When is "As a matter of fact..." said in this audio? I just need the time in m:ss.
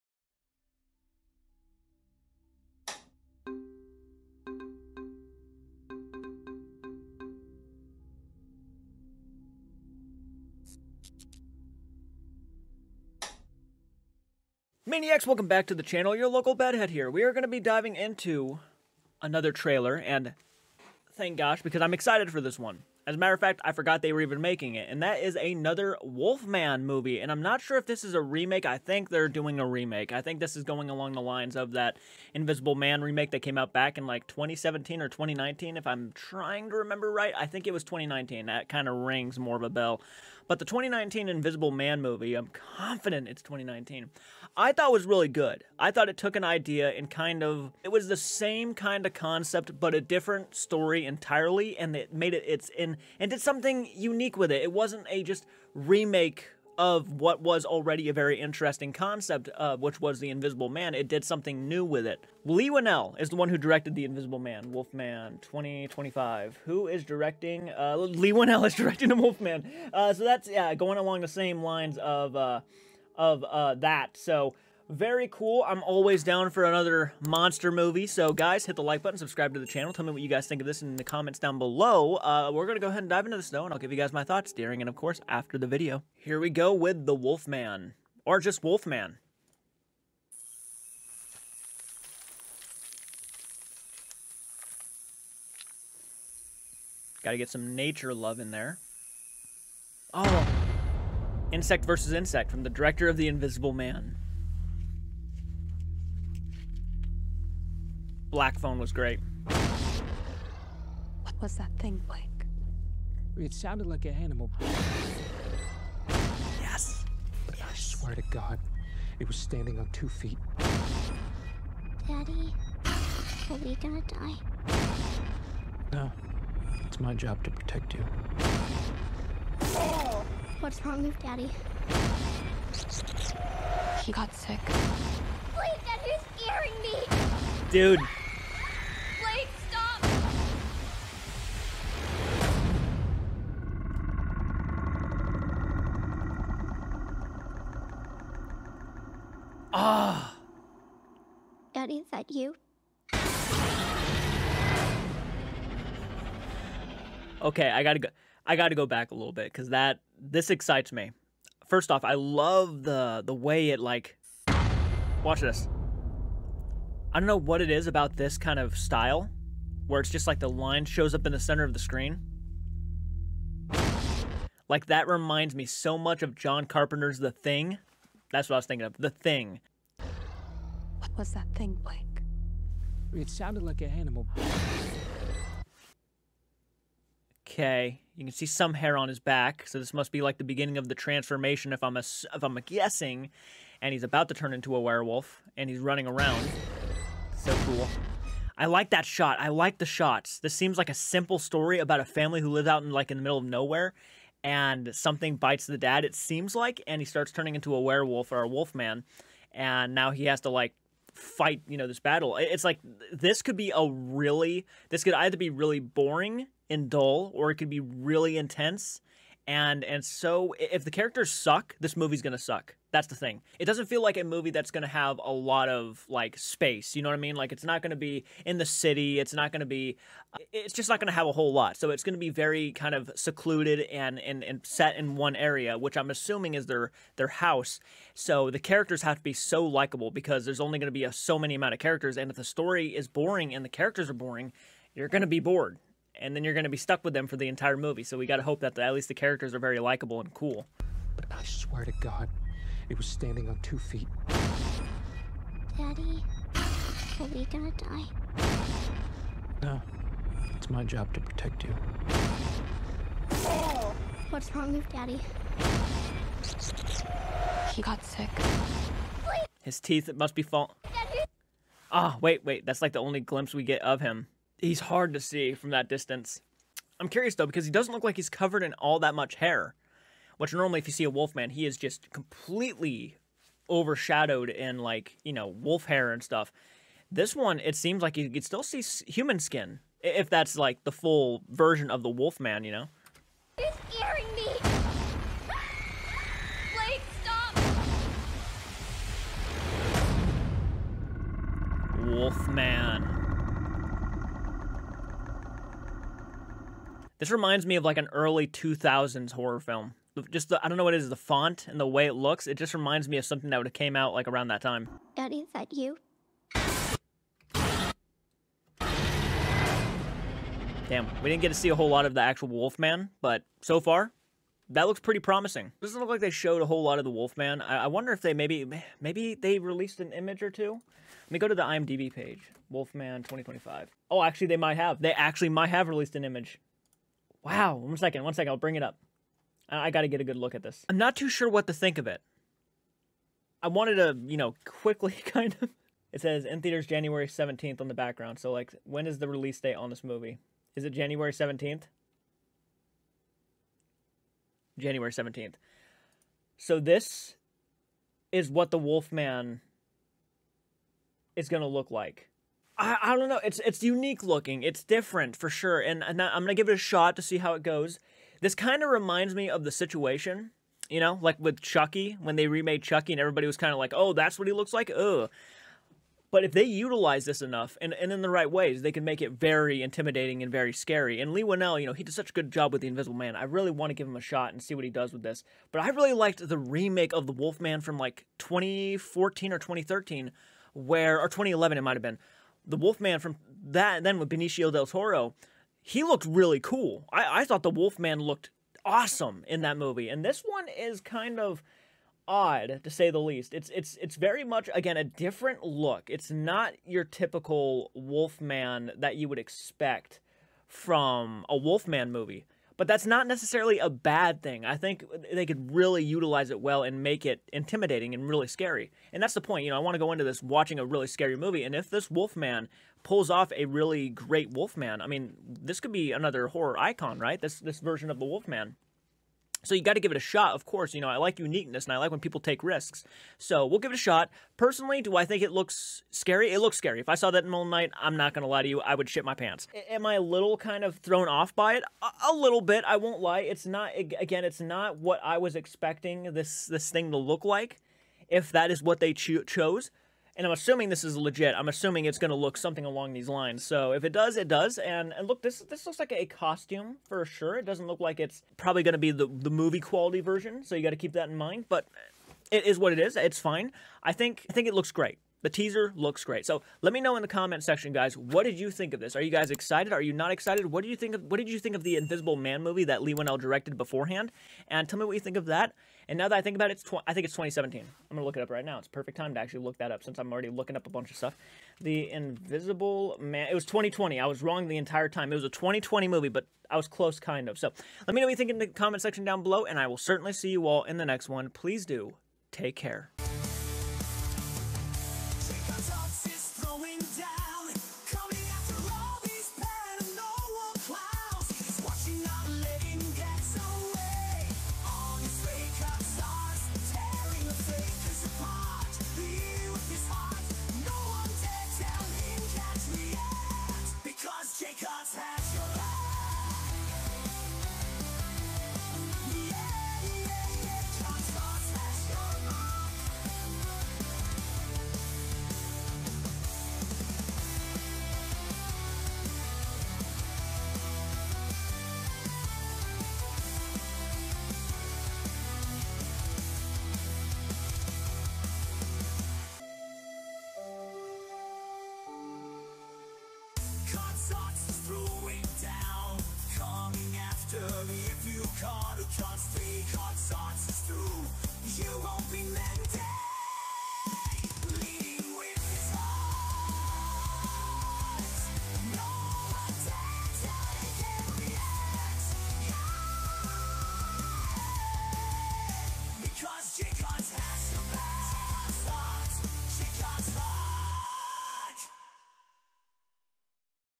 0:23.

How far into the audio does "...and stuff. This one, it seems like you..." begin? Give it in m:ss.
4:46.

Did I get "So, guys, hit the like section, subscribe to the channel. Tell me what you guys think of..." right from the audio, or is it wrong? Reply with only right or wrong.
wrong.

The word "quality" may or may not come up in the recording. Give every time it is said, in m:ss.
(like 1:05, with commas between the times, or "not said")
7:39.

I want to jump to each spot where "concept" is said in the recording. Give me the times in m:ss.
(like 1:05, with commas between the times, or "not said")
0:49, 0:58.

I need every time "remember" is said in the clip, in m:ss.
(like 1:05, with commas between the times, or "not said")
0:36.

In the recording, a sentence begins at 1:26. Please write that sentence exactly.
Here we go with The Wolfman, or just Wolfman.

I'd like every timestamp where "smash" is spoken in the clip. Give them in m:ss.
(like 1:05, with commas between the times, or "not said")
not said.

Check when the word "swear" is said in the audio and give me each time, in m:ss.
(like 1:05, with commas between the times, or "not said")
1:57, 4:11.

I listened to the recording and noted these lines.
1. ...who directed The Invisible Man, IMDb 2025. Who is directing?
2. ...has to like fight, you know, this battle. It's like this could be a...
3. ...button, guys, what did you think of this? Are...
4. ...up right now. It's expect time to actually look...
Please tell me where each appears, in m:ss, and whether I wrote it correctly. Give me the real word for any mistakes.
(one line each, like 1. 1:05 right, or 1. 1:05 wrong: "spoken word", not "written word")
1. 1:03 wrong: "Wolfman", not "IMDb"
2. 3:30 right
3. 7:47 wrong: "section", not "button"
4. 7:58 wrong: "perfect", not "expect".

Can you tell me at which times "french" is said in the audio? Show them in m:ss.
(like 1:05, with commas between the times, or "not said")
not said.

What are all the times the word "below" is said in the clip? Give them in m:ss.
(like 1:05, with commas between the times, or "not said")
1:21, 8:09.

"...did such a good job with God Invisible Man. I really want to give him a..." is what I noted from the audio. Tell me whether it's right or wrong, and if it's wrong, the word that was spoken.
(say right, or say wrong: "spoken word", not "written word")
wrong: "The", not "God".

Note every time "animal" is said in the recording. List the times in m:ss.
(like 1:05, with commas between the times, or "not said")
1:54, 3:03.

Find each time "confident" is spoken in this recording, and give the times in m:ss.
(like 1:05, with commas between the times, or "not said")
0:42.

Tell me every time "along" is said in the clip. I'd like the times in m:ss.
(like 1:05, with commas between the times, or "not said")
0:30, 1:10, 7:32.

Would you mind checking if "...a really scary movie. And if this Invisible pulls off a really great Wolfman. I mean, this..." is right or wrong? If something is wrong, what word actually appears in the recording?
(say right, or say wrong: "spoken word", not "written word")
wrong: "Wolfman", not "Invisible".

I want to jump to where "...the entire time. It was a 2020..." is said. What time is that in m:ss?
8:04.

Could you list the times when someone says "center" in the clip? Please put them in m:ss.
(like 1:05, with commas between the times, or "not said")
2:51.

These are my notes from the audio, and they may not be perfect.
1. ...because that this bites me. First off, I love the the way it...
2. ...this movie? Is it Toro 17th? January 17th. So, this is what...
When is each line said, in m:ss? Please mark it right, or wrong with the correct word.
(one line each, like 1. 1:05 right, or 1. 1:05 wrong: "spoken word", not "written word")
1. 2:39 wrong: "excites", not "bites"
2. 5:49 wrong: "January", not "Toro".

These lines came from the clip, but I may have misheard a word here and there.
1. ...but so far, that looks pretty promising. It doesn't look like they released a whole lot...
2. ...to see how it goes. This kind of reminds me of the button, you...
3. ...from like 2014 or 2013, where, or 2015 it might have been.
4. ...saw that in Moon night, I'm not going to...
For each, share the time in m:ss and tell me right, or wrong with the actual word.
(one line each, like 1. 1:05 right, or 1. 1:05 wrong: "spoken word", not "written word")
1. 5:23 wrong: "showed", not "released"
2. 6:07 wrong: "situation", not "button"
3. 6:27 wrong: "2011", not "2015"
4. 7:17 right.